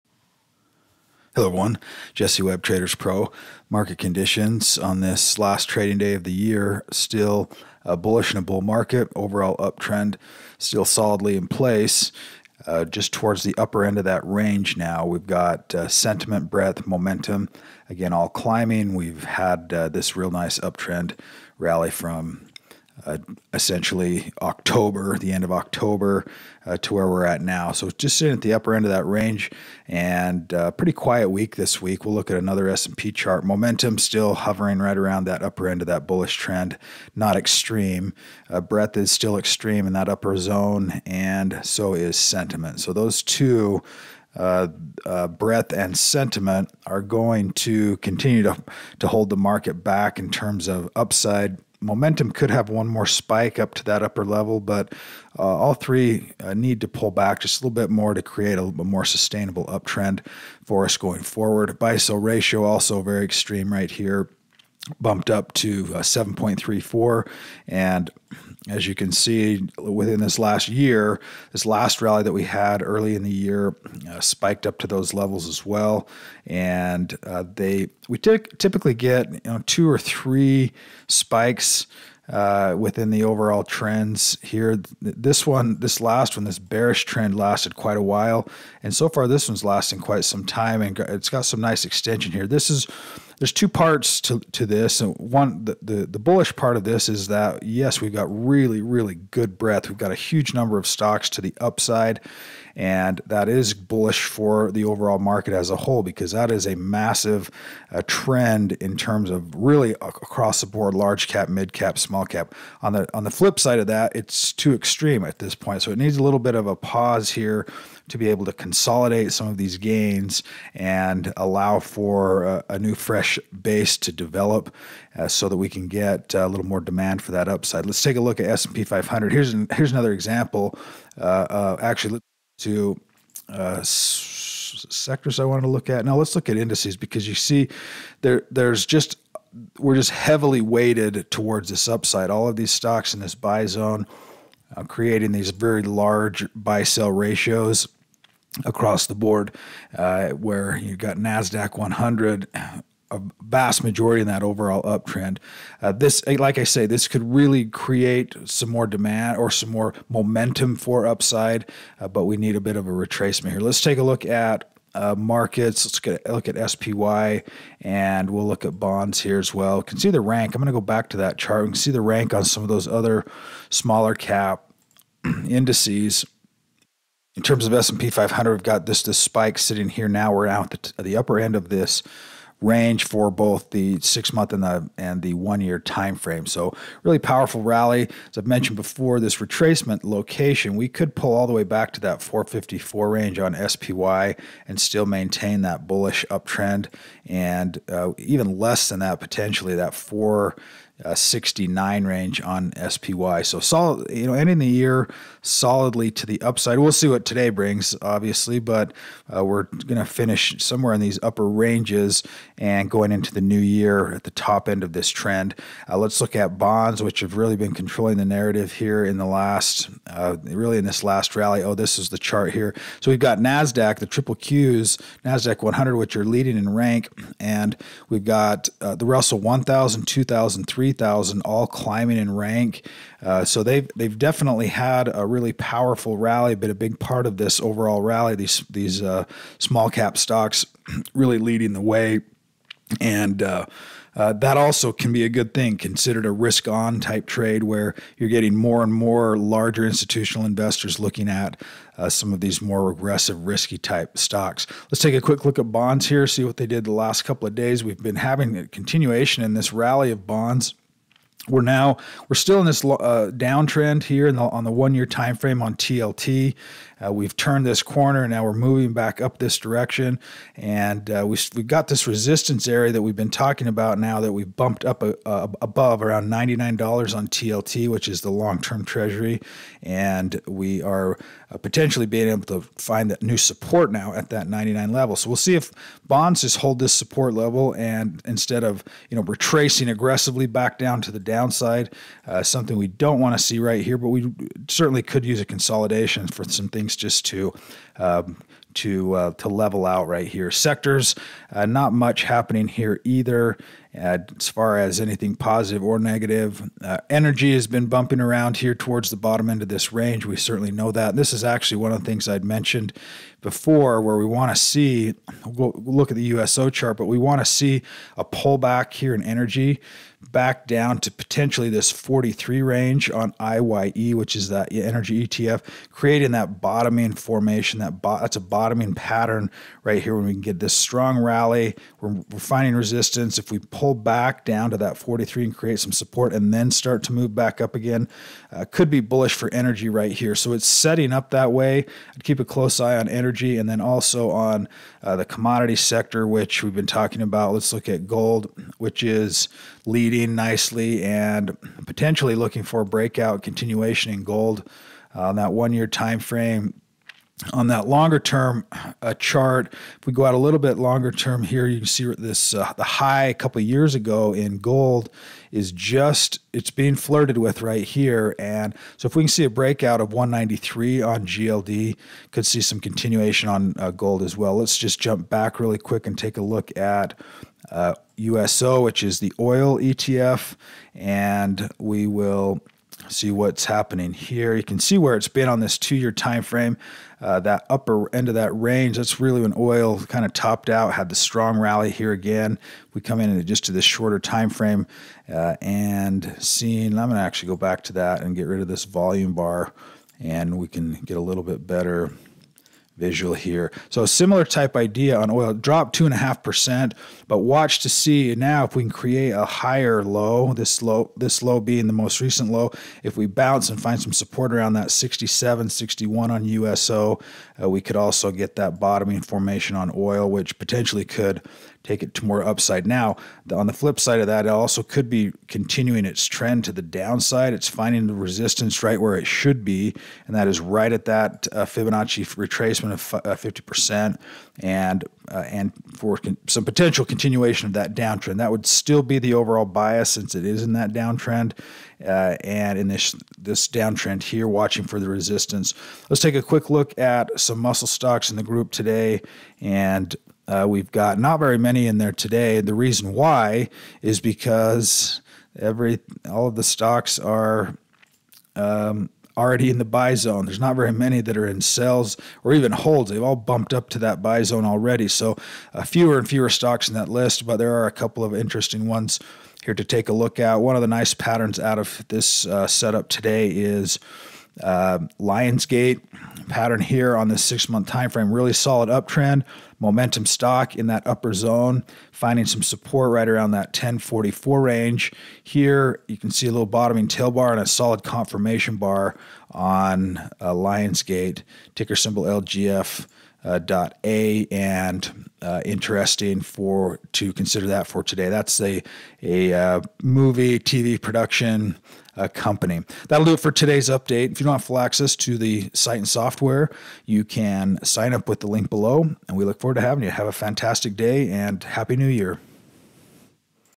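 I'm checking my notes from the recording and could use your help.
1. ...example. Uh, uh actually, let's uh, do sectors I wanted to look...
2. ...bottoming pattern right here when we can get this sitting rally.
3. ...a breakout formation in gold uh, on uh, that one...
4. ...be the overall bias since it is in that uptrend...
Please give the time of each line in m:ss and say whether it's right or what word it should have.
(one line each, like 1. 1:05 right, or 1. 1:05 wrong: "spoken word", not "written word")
1. 2:10 right
2. 5:28 wrong: "strong", not "sitting"
3. 5:52 wrong: "continuation", not "formation"
4. 7:19 wrong: "downtrend", not "uptrend".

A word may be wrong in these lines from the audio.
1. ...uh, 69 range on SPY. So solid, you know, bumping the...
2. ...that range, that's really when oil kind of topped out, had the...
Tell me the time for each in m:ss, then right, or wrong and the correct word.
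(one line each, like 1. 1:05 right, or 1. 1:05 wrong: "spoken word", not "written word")
1. 3:21 wrong: "ending", not "bumping"
2. 6:28 right.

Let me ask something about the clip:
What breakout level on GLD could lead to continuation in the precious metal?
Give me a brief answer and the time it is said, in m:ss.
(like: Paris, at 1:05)
193, at 6:10.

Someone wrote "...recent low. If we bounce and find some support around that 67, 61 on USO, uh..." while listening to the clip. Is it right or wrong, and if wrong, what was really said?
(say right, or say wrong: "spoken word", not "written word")
right.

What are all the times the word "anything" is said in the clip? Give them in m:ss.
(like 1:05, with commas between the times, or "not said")
5:05.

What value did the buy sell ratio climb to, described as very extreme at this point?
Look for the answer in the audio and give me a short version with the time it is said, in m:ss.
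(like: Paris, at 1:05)
7.34, at 1:05.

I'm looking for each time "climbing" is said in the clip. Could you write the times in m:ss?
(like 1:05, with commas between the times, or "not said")
0:18, 3:51.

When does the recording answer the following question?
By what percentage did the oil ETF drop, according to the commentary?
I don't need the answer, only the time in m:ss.
6:45.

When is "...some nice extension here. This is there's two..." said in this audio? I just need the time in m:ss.
1:31.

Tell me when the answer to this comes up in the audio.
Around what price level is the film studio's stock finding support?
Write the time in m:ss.
8:03.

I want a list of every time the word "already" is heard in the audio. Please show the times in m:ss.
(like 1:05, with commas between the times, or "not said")
7:39, 7:44.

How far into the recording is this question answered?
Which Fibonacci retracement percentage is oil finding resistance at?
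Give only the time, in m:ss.
7:13.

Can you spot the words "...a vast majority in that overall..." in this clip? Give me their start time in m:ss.
2:33.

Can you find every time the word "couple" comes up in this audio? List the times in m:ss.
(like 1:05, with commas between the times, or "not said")
4:17, 6:03, 7:47.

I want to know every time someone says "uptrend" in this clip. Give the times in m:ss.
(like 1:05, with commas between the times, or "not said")
0:09, 0:20, 0:59, 2:34, 3:16, 7:58.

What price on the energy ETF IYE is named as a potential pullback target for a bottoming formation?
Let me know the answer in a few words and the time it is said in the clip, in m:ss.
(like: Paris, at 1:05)
43, at 5:21.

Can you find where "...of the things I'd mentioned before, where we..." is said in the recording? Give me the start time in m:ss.
5:11.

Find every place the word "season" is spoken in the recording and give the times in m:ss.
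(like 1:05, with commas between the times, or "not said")
not said.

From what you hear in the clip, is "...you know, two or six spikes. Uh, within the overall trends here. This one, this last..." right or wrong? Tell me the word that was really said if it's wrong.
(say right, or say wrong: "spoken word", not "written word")
wrong: "three", not "six".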